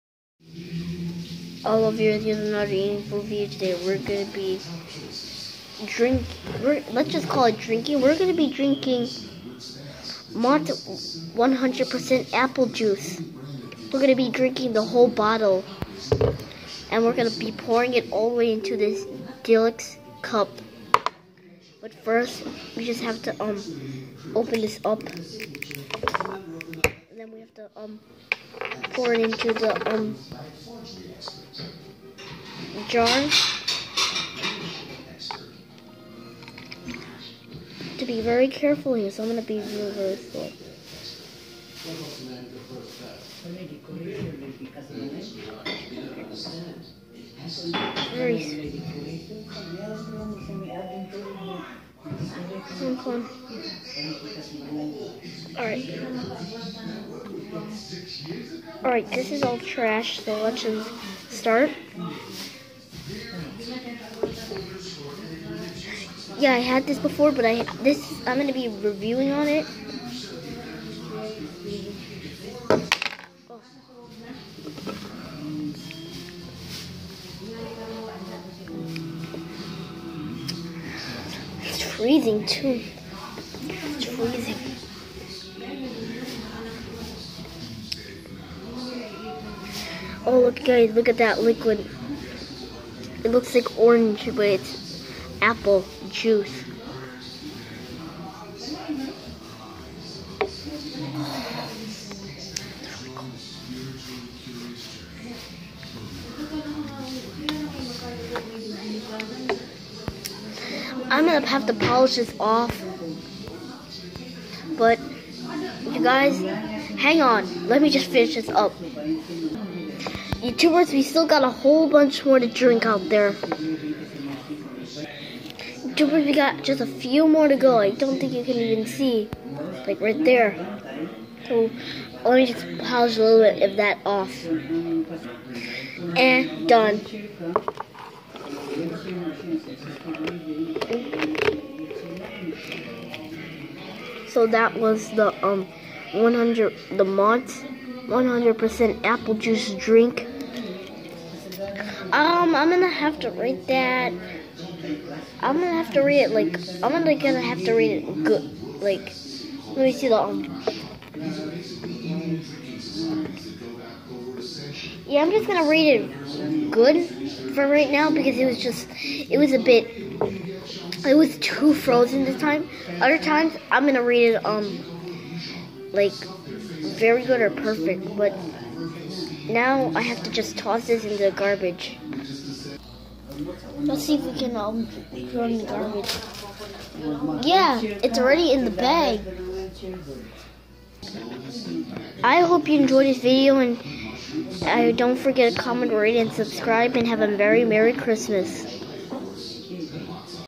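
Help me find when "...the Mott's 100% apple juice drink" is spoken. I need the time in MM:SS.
02:26.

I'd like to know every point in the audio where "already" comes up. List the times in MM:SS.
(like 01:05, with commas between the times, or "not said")
03:08.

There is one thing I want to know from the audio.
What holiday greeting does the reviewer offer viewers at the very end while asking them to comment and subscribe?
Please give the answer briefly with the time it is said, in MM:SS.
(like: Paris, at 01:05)
Merry Christmas, at 03:17.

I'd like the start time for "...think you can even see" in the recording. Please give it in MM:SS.
02:08.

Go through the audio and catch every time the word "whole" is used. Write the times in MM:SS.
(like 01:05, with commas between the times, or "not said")
00:14, 02:01.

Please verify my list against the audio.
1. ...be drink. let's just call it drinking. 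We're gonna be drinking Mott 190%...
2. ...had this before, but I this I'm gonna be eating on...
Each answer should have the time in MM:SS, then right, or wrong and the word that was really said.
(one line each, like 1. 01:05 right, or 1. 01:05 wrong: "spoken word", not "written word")
1. 00:04 wrong: "100", not "190"
2. 01:06 wrong: "reviewing", not "eating".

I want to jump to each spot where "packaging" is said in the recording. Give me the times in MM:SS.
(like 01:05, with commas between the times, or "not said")
not said.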